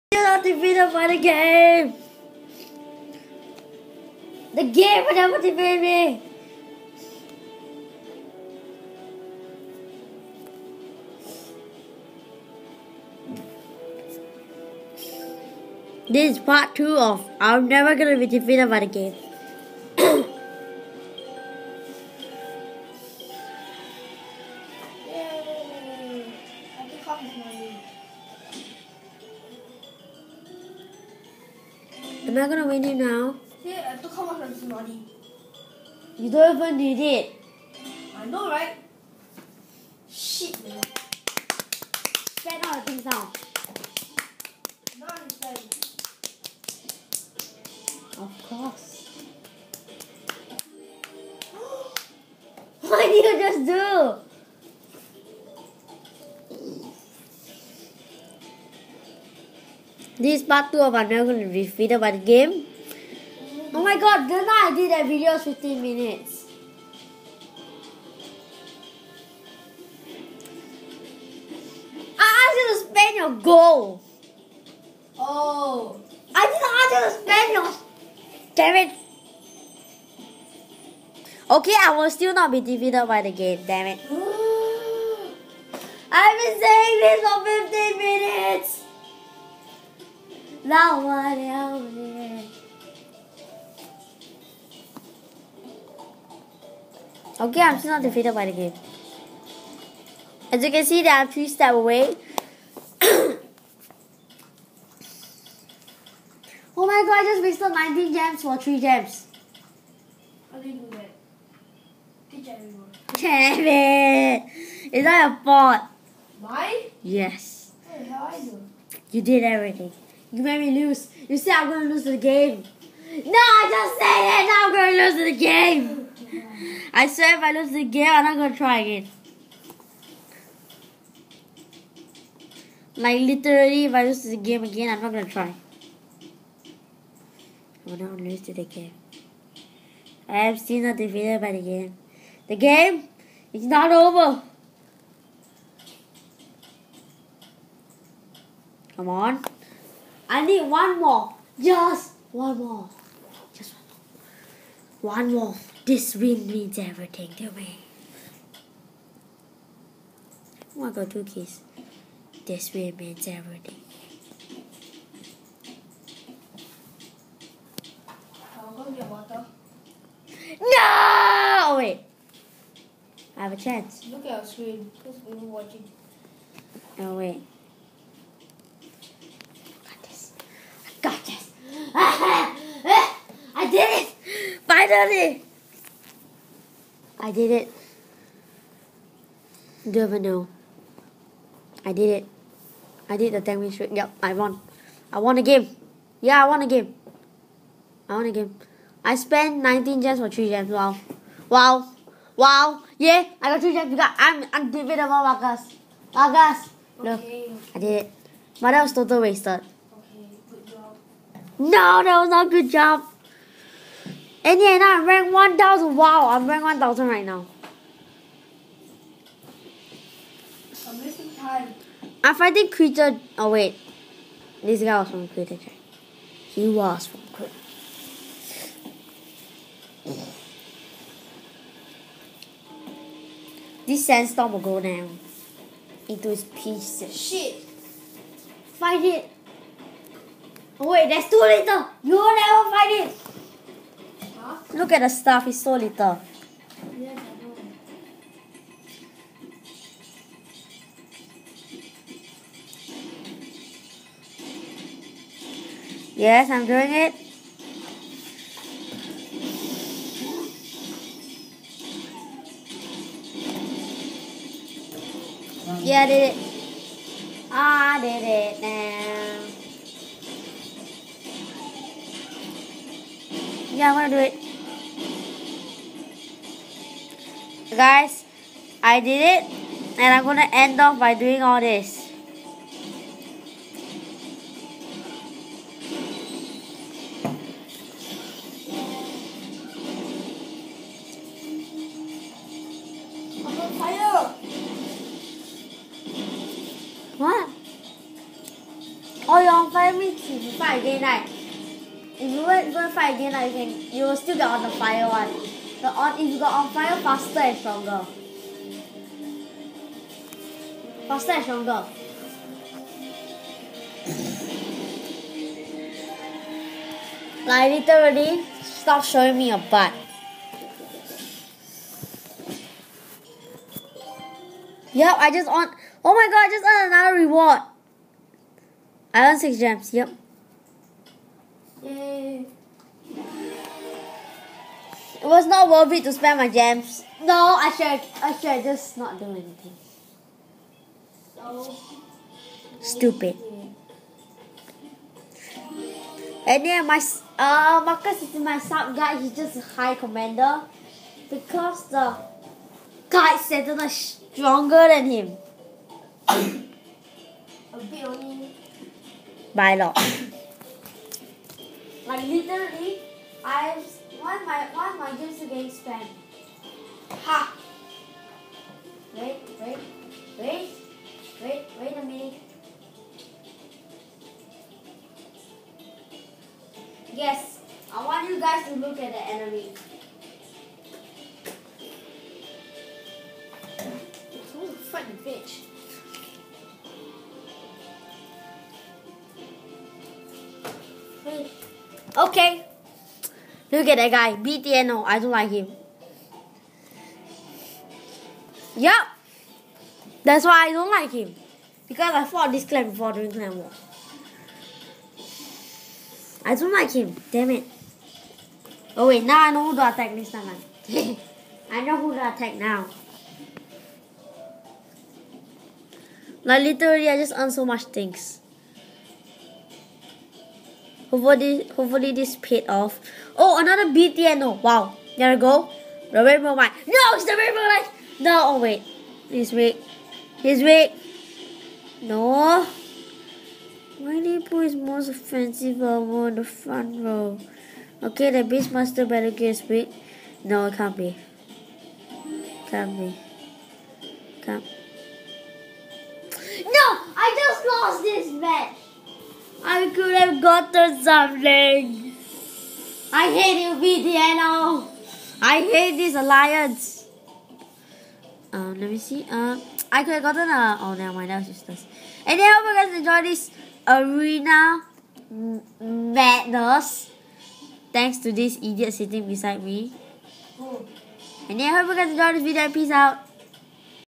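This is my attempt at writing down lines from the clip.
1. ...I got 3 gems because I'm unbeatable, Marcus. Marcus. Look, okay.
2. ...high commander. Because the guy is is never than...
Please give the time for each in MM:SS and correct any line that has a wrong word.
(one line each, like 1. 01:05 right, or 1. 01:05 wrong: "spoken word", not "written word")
1. 03:23 right
2. 05:49 wrong: "stronger", not "never".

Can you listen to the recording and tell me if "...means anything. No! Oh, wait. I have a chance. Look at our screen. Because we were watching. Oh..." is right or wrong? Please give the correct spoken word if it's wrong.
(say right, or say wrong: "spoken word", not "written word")
wrong: "everything", not "anything".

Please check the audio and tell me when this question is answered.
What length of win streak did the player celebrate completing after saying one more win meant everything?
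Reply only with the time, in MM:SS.
03:13.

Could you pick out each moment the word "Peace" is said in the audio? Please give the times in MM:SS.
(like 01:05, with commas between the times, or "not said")
07:52.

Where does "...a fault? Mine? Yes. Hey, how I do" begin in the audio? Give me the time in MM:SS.
01:55.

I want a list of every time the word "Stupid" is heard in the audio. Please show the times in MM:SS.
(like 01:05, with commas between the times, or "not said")
05:42.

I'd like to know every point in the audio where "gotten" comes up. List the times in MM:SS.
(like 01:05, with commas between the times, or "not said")
07:30, 07:40.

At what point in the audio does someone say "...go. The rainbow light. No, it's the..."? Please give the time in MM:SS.
07:05.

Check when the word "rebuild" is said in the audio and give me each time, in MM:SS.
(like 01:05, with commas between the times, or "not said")
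not said.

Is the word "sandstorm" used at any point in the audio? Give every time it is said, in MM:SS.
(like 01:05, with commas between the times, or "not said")
03:54.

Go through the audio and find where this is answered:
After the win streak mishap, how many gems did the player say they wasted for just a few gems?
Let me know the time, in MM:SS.
01:47.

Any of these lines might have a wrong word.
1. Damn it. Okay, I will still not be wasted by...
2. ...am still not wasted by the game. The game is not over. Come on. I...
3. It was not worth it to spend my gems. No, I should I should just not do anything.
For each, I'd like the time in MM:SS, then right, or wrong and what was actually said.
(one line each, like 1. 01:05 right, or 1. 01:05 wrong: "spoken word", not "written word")
1. 01:18 wrong: "defeated", not "wasted"
2. 02:20 wrong: "defeated", not "wasted"
3. 05:35 right.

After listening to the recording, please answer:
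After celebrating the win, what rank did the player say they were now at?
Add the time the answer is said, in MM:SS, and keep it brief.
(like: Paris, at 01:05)
1,000, at 03:36.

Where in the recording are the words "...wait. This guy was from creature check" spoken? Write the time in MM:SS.
03:43.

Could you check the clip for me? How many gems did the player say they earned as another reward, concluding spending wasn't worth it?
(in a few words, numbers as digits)
6.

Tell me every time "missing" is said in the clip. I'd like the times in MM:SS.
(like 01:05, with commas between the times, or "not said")
03:41.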